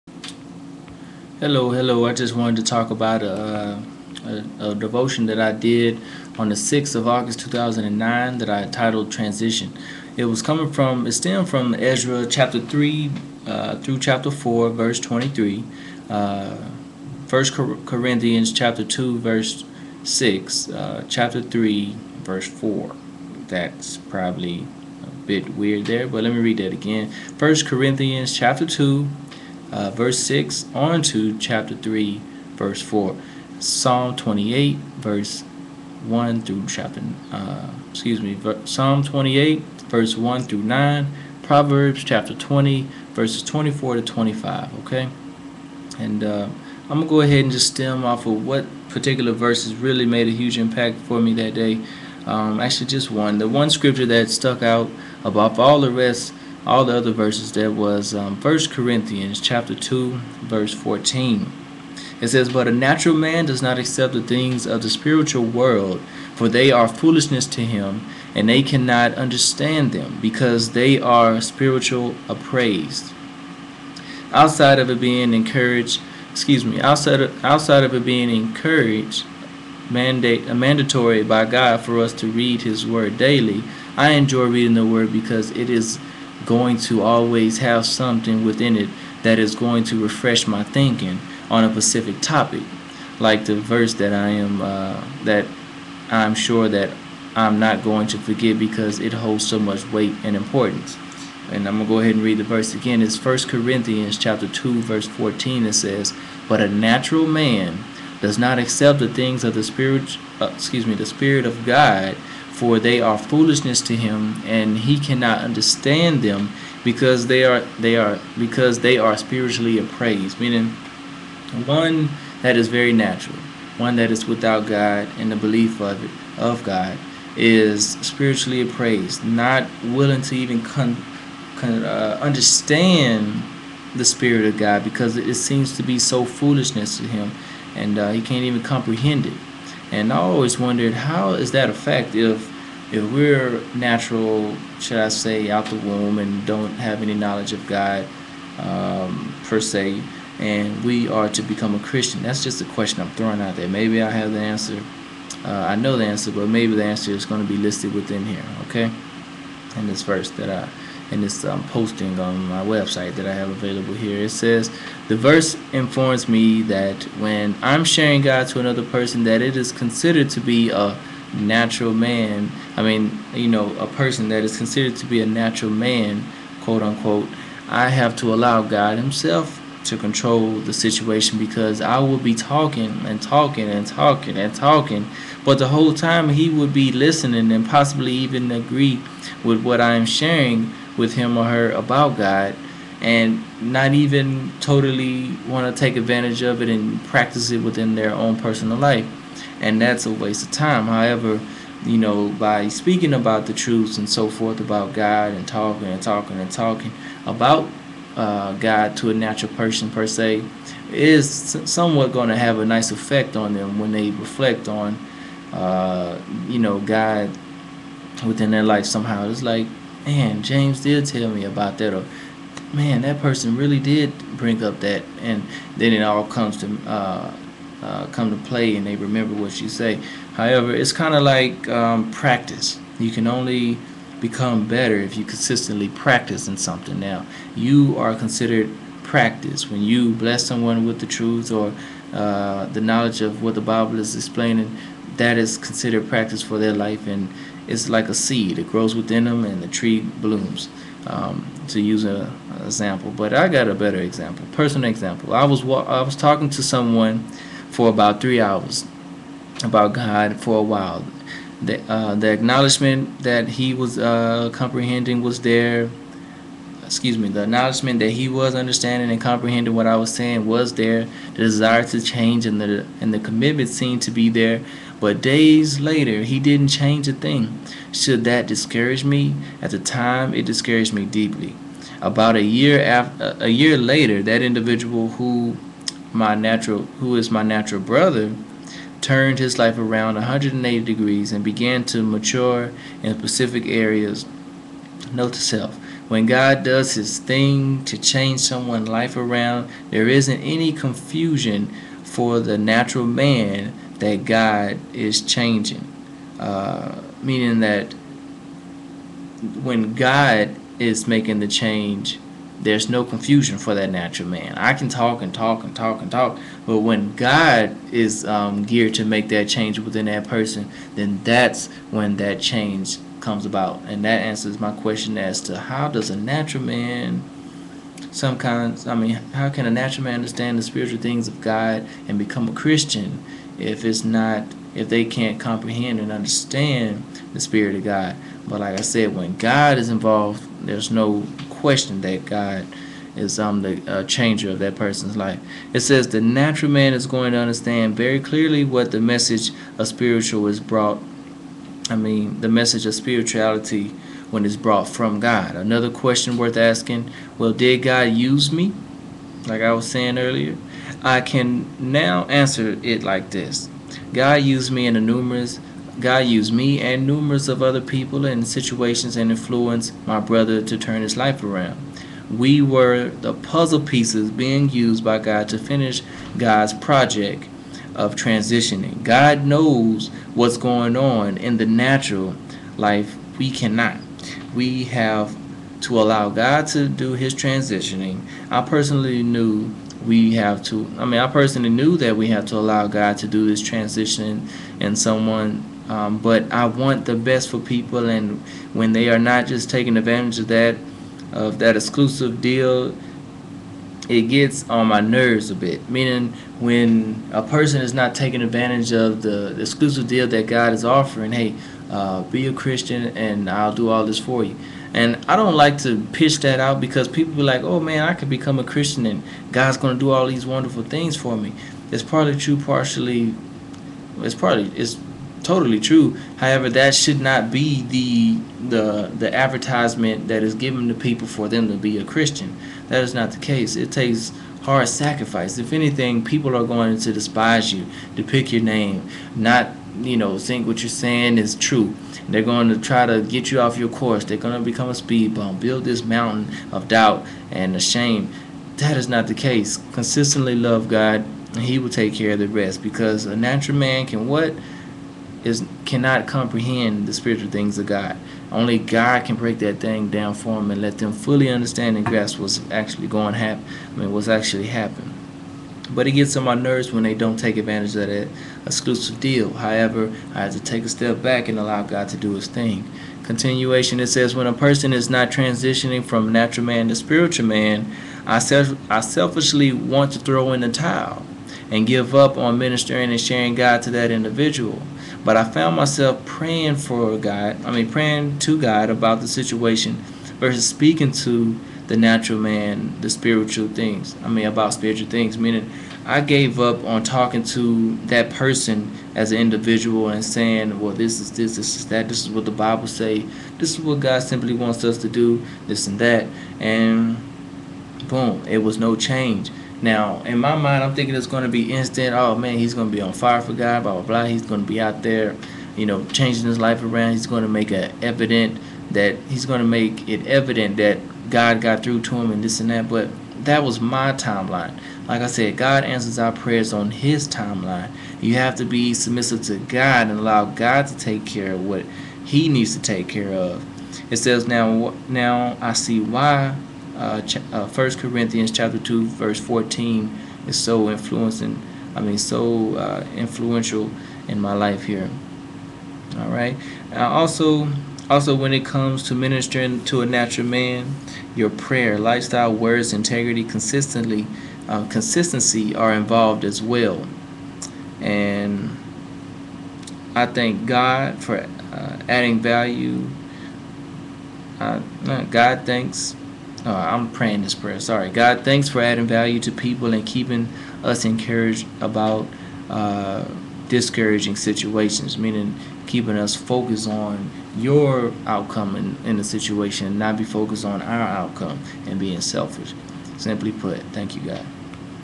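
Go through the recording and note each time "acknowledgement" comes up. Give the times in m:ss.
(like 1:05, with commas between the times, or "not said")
4:22, 4:27.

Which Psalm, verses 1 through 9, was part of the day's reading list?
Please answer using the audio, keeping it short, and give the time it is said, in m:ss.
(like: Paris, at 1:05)
Psalm 28, at 0:38.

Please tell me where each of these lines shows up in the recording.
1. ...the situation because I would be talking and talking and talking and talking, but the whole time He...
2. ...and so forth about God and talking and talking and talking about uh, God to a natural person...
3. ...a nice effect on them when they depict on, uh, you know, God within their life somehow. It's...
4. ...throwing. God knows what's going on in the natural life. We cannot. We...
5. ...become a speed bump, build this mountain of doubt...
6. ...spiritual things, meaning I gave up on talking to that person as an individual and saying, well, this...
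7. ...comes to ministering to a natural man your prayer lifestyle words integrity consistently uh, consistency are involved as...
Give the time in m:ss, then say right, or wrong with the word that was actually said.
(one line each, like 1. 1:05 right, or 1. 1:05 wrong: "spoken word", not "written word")
1. 3:00 right
2. 3:23 right
3. 3:32 wrong: "reflect", not "depict"
4. 6:18 wrong: "transitioning", not "throwing"
5. 7:24 right
6. 8:14 right
7. 9:08 right.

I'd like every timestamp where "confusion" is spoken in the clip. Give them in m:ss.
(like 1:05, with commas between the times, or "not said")
5:00, 5:13.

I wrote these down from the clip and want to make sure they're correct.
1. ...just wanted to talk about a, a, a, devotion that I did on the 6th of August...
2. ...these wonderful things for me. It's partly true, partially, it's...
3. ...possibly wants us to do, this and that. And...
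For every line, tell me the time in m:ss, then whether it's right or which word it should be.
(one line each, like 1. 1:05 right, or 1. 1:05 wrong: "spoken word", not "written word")
1. 0:02 right
2. 7:00 right
3. 8:24 wrong: "simply", not "possibly".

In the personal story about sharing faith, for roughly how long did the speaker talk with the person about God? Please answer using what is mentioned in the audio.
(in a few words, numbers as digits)
3 hours.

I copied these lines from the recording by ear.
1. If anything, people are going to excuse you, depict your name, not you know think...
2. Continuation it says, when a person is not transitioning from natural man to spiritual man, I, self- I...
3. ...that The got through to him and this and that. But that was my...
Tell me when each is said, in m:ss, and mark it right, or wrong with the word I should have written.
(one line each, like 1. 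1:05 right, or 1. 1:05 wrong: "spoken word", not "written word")
1. 7:15 wrong: "despise", not "excuse"
2. 7:53 right
3. 8:40 wrong: "God", not "The".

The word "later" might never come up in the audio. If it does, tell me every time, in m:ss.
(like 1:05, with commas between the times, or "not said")
4:35, 4:43.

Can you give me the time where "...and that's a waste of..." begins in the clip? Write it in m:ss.
3:19.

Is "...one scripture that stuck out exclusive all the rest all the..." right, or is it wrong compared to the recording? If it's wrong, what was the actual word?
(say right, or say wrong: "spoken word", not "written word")
wrong: "above", not "exclusive".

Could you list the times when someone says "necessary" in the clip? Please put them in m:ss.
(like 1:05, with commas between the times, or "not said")
not said.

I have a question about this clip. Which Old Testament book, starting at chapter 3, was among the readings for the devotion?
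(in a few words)
Ezra.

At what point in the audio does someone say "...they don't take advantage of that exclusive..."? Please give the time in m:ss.
7:47.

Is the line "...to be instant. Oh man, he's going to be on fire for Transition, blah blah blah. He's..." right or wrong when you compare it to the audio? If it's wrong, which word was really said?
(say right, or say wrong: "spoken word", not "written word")
wrong: "God", not "Transition".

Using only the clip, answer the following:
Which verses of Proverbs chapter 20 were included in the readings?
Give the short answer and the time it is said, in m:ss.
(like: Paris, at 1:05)
24 to 25, at 0:43.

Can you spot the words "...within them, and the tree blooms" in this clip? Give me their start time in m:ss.
4:08.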